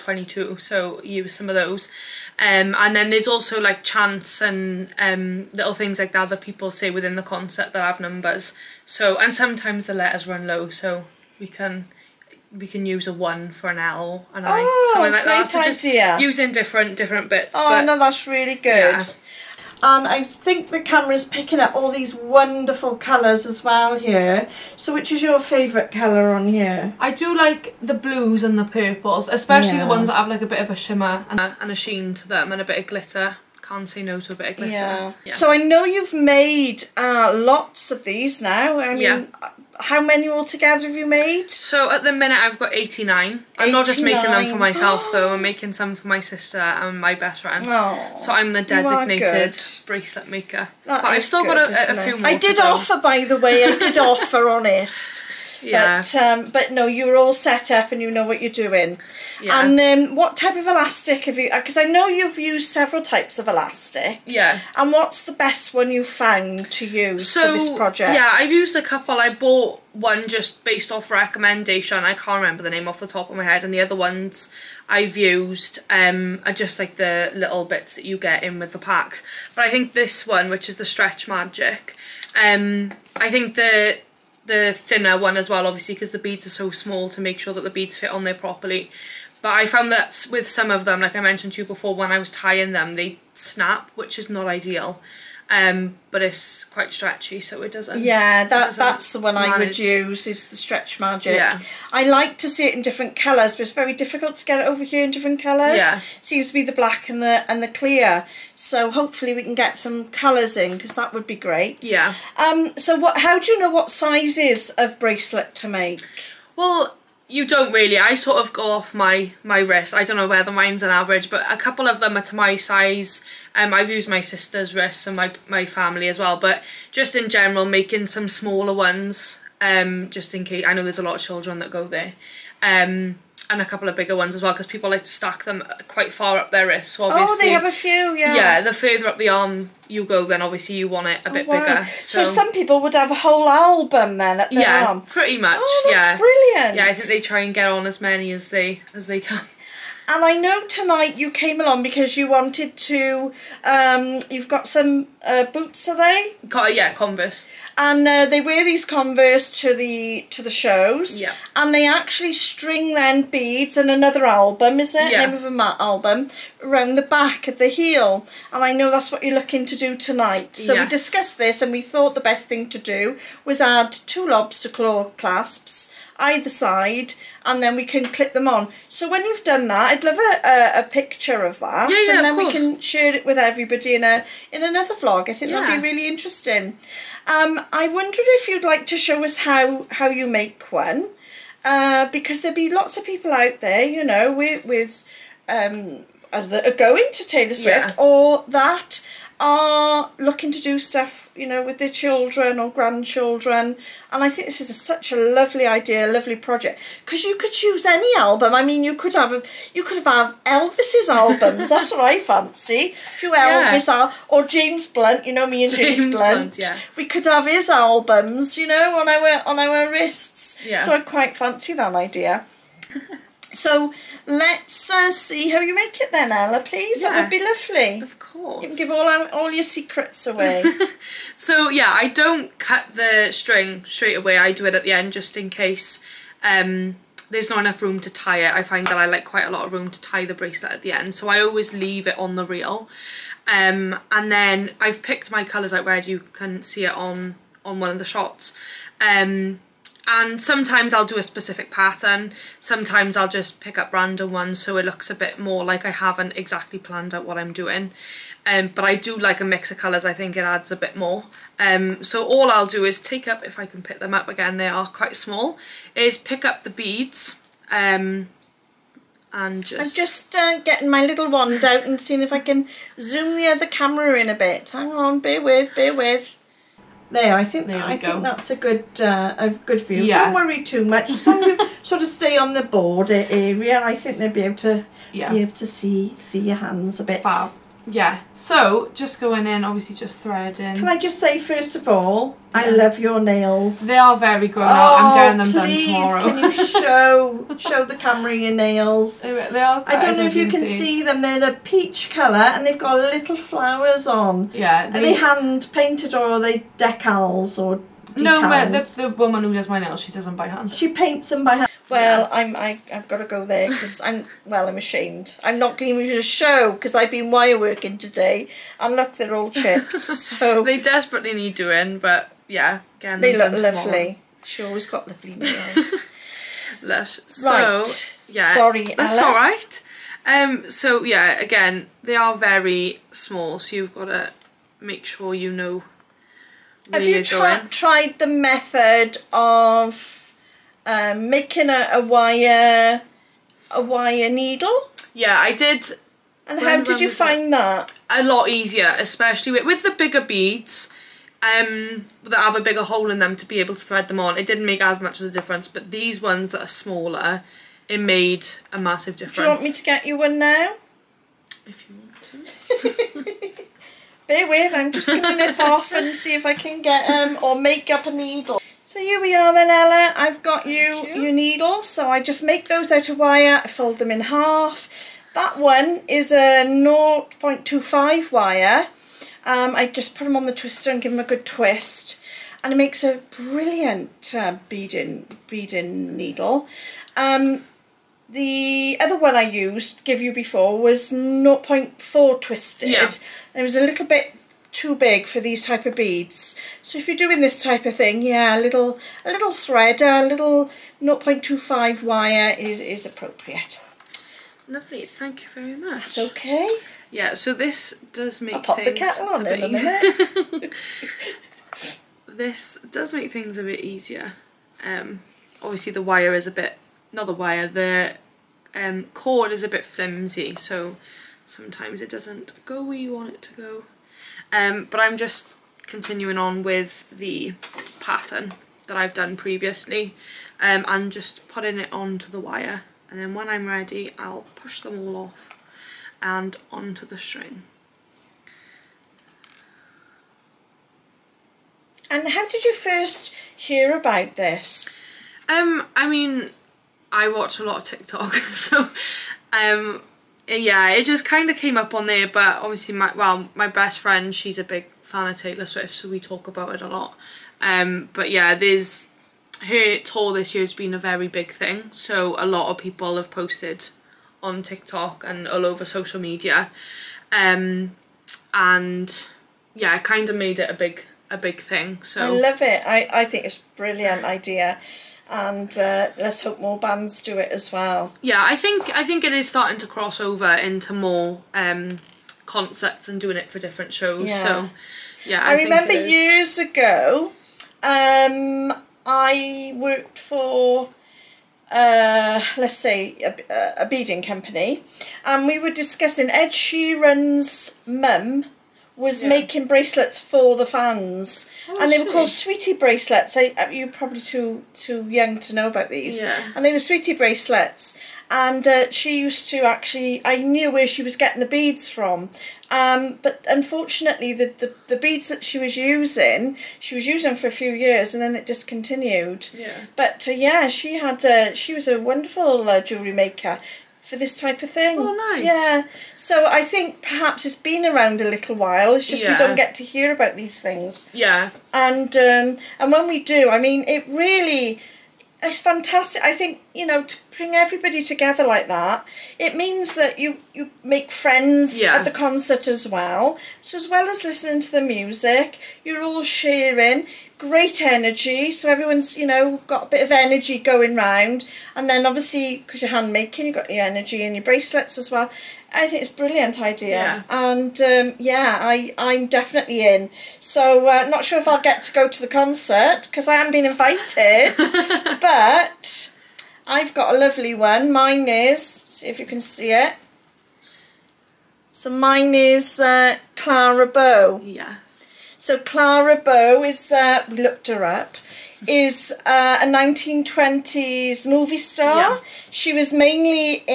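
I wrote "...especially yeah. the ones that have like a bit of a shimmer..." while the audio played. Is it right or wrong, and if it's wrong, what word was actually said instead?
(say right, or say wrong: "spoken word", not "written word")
right.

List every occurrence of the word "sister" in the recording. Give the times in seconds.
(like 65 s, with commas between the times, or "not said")
46 s, 124 s.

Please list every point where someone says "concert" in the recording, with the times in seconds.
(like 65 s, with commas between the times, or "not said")
7 s, 542 s, 562 s.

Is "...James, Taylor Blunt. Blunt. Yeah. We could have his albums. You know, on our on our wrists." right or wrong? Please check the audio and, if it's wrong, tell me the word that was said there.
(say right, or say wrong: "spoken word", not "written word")
wrong: "James", not "Taylor".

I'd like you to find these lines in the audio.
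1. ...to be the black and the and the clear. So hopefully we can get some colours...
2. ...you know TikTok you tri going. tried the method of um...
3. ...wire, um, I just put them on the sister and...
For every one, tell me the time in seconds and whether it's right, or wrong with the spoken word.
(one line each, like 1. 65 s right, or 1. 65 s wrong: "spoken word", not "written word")
1. 106 s right
2. 335 s wrong: "Have", not "TikTok"
3. 378 s wrong: "twister", not "sister".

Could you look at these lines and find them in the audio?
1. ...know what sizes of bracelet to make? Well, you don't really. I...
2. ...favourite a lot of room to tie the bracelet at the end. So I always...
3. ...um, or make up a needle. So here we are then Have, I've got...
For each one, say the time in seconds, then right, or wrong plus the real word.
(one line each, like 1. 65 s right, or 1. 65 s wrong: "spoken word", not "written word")
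1. 113 s right
2. 239 s wrong: "quite", not "favourite"
3. 367 s wrong: "Ella", not "Have".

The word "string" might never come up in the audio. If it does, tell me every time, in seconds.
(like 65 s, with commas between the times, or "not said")
162 s, 233 s, 437 s.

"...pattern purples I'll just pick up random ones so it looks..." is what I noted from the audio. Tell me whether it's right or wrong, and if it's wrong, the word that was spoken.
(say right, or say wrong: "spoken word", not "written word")
wrong: "sometimes", not "purples".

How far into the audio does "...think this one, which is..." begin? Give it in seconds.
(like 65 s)
79 s.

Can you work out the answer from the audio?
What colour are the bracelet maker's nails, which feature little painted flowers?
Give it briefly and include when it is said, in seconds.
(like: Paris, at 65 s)
Peach, at 301 s.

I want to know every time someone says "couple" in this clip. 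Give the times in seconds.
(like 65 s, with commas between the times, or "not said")
68 s, 121 s, 133 s.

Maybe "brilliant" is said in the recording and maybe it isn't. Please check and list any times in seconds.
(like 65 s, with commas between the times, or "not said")
146 s, 383 s, 473 s, 556 s.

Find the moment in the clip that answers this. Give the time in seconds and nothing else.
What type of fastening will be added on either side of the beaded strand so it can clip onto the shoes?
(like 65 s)
174 s.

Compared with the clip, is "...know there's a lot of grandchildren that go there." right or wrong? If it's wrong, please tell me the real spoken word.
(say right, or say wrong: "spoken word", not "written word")
wrong: "children", not "grandchildren".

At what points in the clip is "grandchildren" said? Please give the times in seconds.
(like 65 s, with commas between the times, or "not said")
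202 s.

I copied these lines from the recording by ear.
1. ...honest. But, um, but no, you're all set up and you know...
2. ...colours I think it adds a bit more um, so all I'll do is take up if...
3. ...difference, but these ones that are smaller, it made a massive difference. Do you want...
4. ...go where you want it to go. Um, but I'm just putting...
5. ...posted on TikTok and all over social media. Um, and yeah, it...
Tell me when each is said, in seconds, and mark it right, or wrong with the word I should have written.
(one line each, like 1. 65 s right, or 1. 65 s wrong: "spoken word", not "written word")
1. 54 s right
2. 259 s right
3. 355 s right
4. 422 s wrong: "continuing", not "putting"
5. 463 s right.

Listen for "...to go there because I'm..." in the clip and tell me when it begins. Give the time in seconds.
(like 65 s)
313 s.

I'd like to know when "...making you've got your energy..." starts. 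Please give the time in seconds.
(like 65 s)
553 s.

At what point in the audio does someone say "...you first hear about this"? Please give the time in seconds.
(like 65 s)
442 s.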